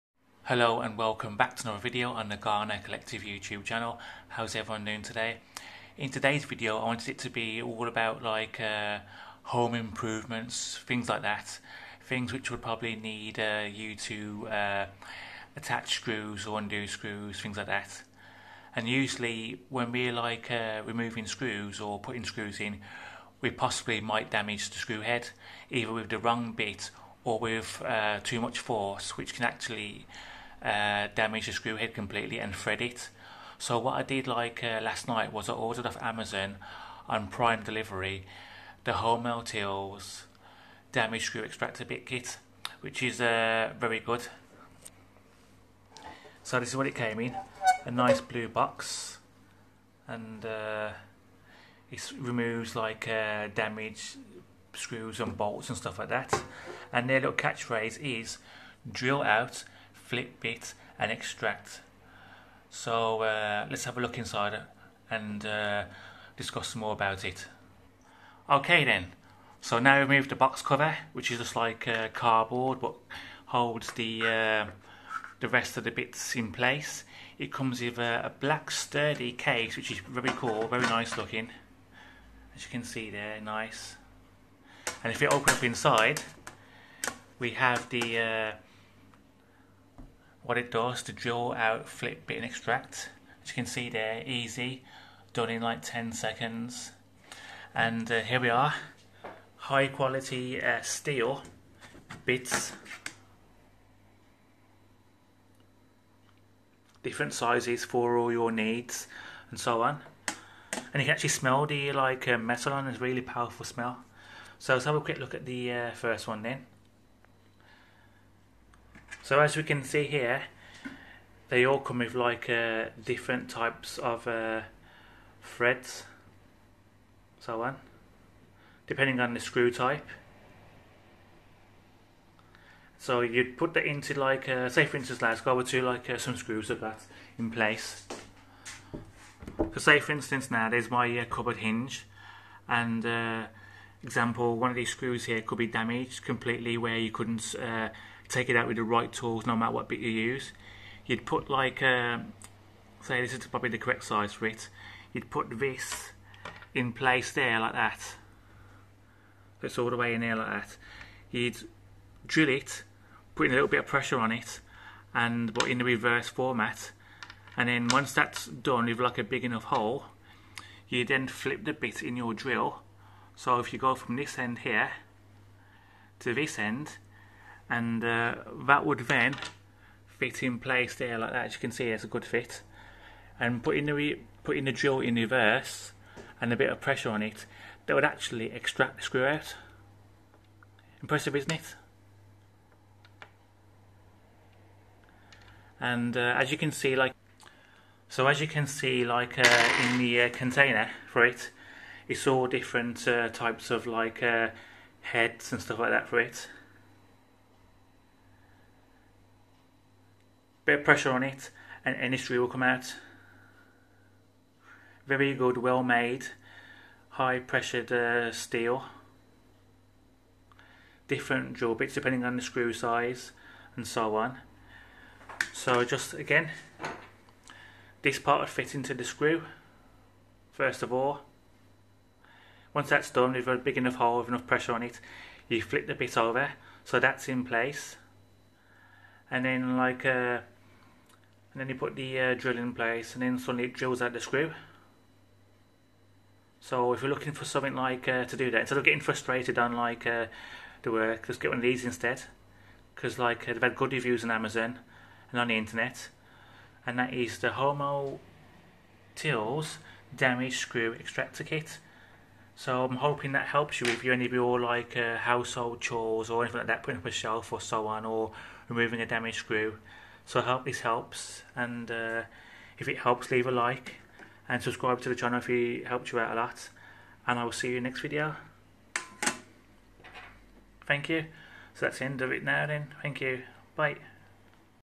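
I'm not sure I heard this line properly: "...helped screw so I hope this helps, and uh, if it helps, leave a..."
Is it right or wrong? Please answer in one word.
wrong.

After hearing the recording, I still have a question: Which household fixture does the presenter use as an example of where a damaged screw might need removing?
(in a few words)
Cupboard hinge.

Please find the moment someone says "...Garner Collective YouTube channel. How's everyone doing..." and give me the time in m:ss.
0:02.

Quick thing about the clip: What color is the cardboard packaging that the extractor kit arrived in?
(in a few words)
Blue.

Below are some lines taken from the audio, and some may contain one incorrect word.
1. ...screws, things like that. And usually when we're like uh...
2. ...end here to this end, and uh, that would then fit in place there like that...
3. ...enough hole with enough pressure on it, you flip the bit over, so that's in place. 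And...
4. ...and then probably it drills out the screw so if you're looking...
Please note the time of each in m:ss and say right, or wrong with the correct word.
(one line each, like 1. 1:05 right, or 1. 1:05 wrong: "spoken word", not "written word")
1. 0:16 right
2. 2:54 right
3. 3:53 right
4. 4:03 wrong: "suddenly", not "probably".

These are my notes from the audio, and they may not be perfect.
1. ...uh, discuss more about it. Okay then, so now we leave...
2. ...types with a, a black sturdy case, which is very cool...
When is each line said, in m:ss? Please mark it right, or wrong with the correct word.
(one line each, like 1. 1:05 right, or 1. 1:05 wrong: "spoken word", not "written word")
1. 1:05 wrong: "remove", not "leave"
2. 1:17 wrong: "comes", not "types".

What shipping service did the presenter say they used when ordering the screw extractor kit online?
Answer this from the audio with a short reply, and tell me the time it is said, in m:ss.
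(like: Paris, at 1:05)
Prime Delivery, at 0:37.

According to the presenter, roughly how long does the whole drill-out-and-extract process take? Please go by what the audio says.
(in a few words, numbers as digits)
10 seconds.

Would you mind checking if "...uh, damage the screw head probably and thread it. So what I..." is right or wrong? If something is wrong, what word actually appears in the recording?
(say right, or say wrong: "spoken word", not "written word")
wrong: "completely", not "probably".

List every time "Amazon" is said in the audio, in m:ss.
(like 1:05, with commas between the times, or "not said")
0:36, 4:14.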